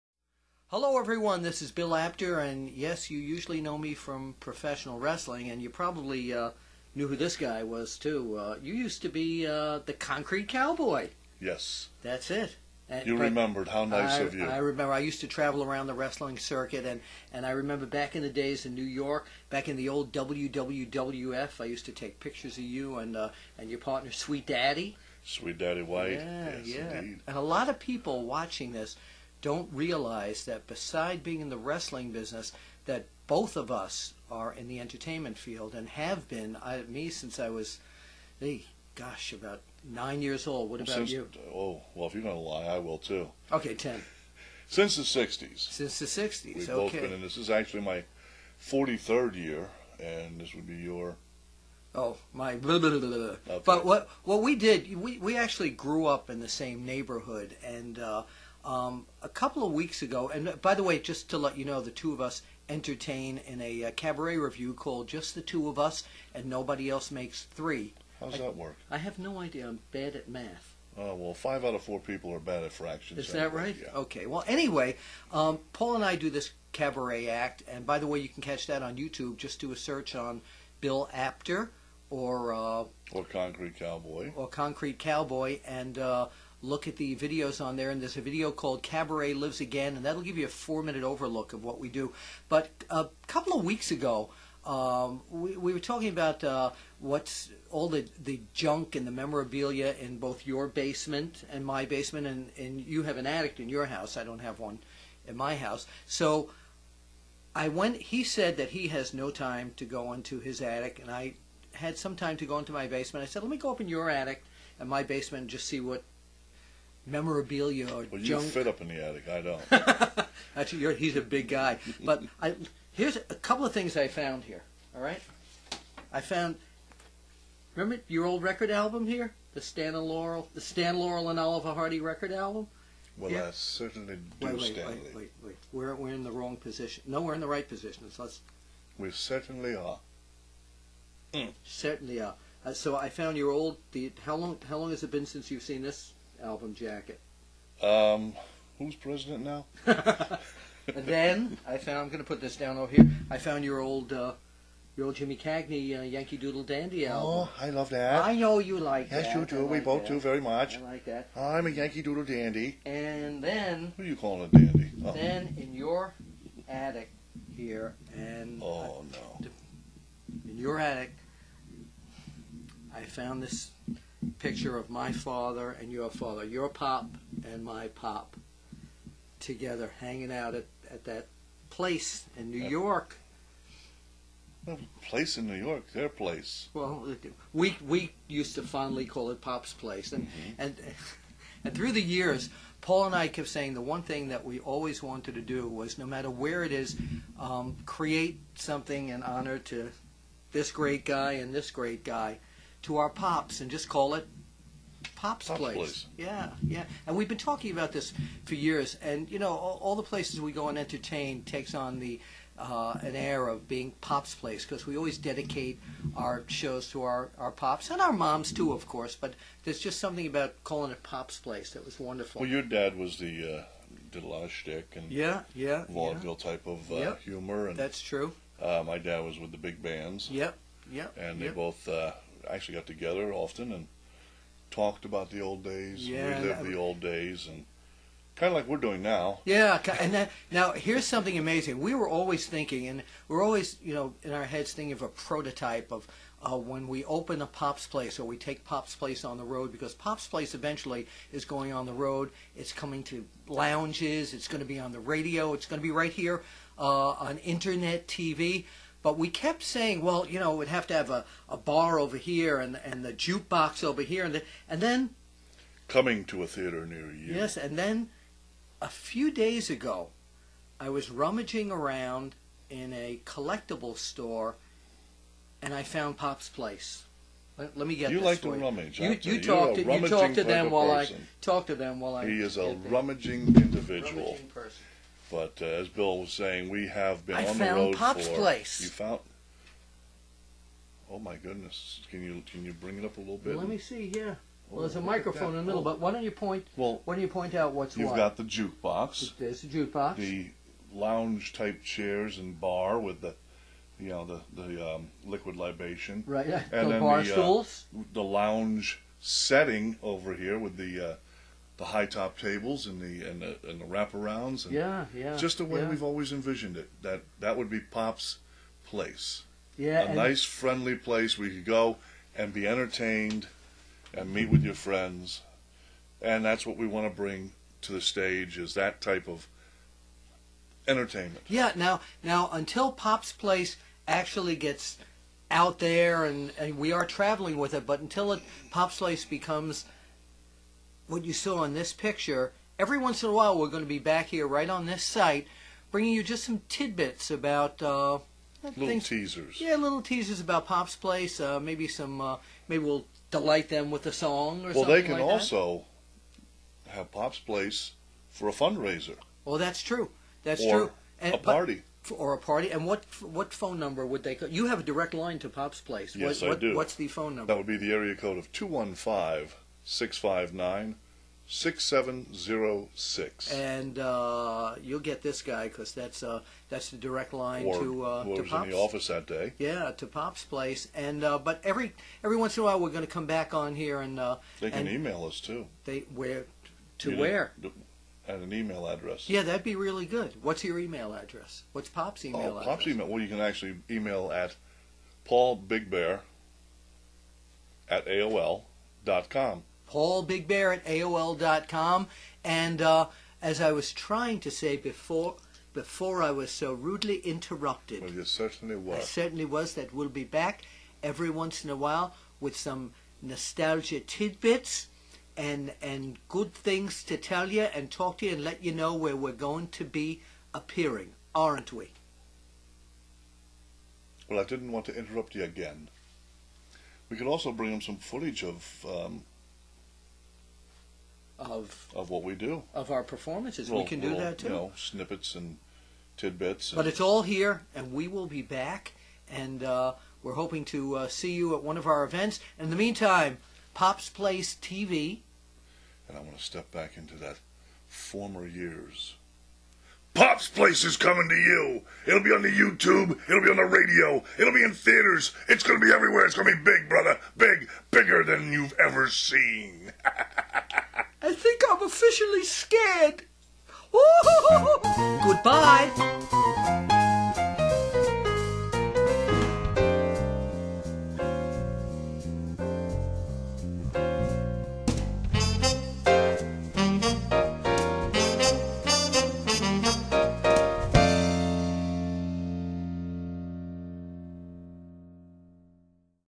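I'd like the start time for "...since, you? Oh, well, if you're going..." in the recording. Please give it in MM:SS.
00:40.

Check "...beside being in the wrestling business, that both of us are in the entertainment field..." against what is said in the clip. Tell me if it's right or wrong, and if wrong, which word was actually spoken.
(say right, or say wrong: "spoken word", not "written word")
right.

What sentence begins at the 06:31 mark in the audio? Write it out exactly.
What's Pop's oh, email oh, address?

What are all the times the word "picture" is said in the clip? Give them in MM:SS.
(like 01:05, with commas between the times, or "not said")
00:22, 02:54, 05:41.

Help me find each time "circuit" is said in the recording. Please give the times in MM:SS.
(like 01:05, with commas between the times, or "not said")
00:16.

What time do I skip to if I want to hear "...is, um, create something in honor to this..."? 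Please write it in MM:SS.
03:16.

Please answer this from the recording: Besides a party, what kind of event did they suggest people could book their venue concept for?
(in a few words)
A fundraiser.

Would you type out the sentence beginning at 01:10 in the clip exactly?
Oh, well, five out of four people are bad at fractions.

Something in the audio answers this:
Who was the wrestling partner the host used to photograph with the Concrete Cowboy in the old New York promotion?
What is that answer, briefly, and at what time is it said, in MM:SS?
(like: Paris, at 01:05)
Sweet Daddy White, at 00:25.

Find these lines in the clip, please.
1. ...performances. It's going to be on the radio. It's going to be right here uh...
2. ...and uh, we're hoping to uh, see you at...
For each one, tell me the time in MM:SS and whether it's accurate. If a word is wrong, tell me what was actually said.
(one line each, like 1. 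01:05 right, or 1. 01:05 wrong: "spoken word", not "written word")
1. 04:13 wrong: "lounges", not "performances"
2. 07:19 right.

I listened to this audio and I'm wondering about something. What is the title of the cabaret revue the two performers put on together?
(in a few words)
Just the Two of Us.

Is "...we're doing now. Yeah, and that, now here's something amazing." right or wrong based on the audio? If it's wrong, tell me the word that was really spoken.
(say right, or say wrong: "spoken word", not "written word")
right.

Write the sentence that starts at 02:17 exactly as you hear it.
No, we're in the right position.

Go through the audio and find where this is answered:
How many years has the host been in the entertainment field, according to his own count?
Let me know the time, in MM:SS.
00:48.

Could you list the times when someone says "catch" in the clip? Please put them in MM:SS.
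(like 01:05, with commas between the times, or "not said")
01:18.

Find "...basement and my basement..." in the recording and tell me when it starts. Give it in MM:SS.
01:40.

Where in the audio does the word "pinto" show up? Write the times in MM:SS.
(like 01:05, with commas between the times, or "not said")
not said.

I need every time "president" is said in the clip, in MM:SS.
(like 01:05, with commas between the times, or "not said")
02:28.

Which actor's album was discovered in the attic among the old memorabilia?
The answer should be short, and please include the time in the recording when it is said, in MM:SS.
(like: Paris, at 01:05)
Jimmy Cagney, at 02:35.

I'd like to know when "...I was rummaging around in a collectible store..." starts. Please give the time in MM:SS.
04:30.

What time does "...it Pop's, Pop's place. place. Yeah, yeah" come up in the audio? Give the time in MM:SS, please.
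03:24.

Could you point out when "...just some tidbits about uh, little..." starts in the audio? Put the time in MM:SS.
05:46.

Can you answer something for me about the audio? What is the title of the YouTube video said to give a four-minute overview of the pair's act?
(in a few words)
Cabaret Lives Again.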